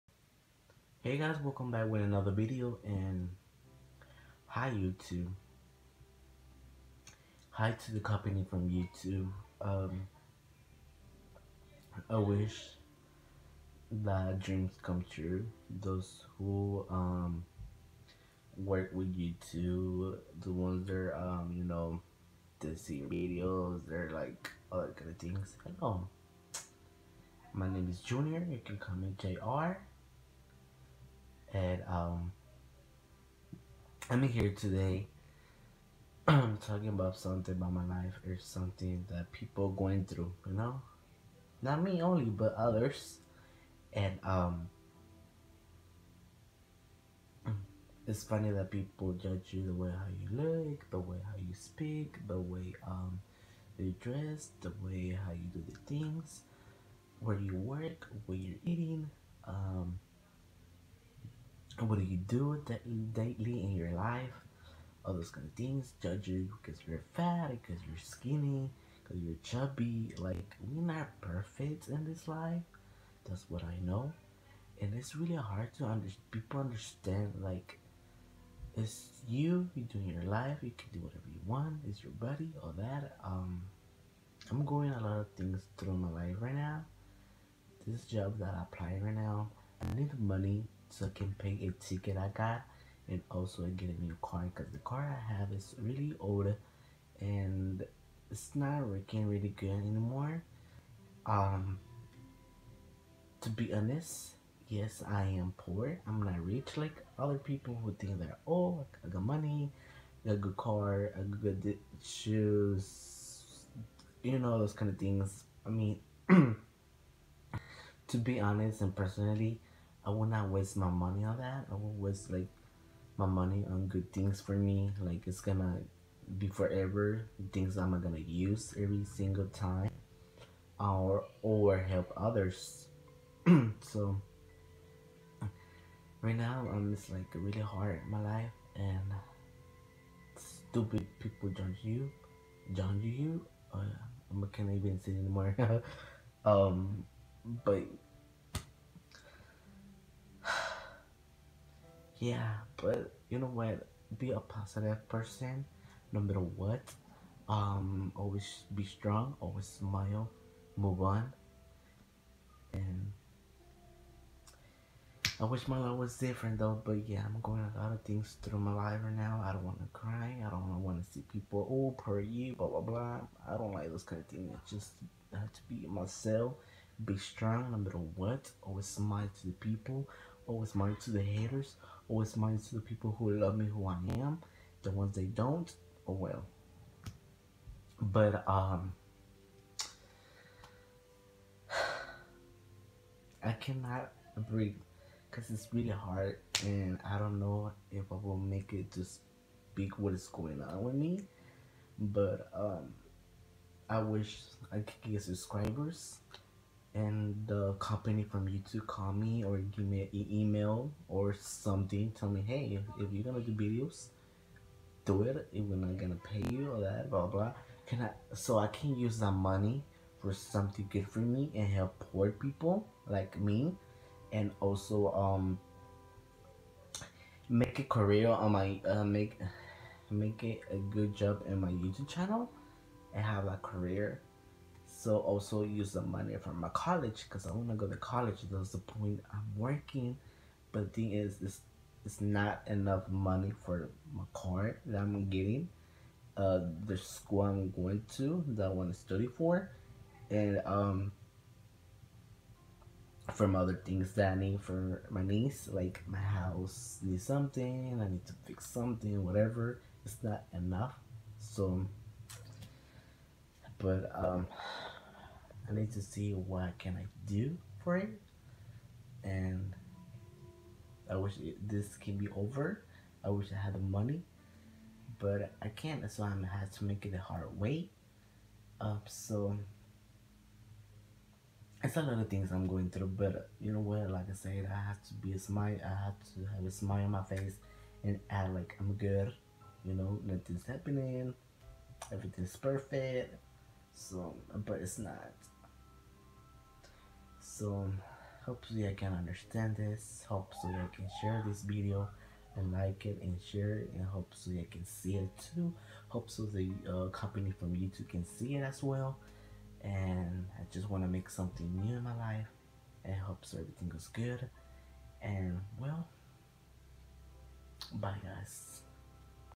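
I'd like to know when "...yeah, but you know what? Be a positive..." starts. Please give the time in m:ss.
2:32.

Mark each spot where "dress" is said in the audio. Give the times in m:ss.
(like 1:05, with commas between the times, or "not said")
0:53.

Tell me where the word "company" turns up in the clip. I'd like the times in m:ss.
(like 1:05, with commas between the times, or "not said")
0:08, 3:27, 5:07.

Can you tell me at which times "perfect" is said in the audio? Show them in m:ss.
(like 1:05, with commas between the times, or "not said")
1:11, 4:52.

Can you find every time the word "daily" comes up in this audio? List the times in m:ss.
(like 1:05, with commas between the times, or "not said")
1:03.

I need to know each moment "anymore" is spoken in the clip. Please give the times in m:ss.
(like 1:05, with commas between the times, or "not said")
1:39, 2:25.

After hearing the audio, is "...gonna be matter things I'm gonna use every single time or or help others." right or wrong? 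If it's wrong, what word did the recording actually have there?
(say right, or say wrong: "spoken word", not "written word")
wrong: "forever", not "matter".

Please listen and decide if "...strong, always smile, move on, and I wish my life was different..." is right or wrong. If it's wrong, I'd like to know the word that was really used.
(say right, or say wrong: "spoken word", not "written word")
right.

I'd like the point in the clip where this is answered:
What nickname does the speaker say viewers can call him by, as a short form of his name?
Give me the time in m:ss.
0:29.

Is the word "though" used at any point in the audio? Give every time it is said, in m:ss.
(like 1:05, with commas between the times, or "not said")
2:46.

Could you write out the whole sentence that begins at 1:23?
Um, I'm going a lot of things through my life right now.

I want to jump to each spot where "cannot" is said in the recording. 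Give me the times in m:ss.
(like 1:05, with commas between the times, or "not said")
3:13.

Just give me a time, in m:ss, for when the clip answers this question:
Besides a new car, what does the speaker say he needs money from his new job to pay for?
1:31.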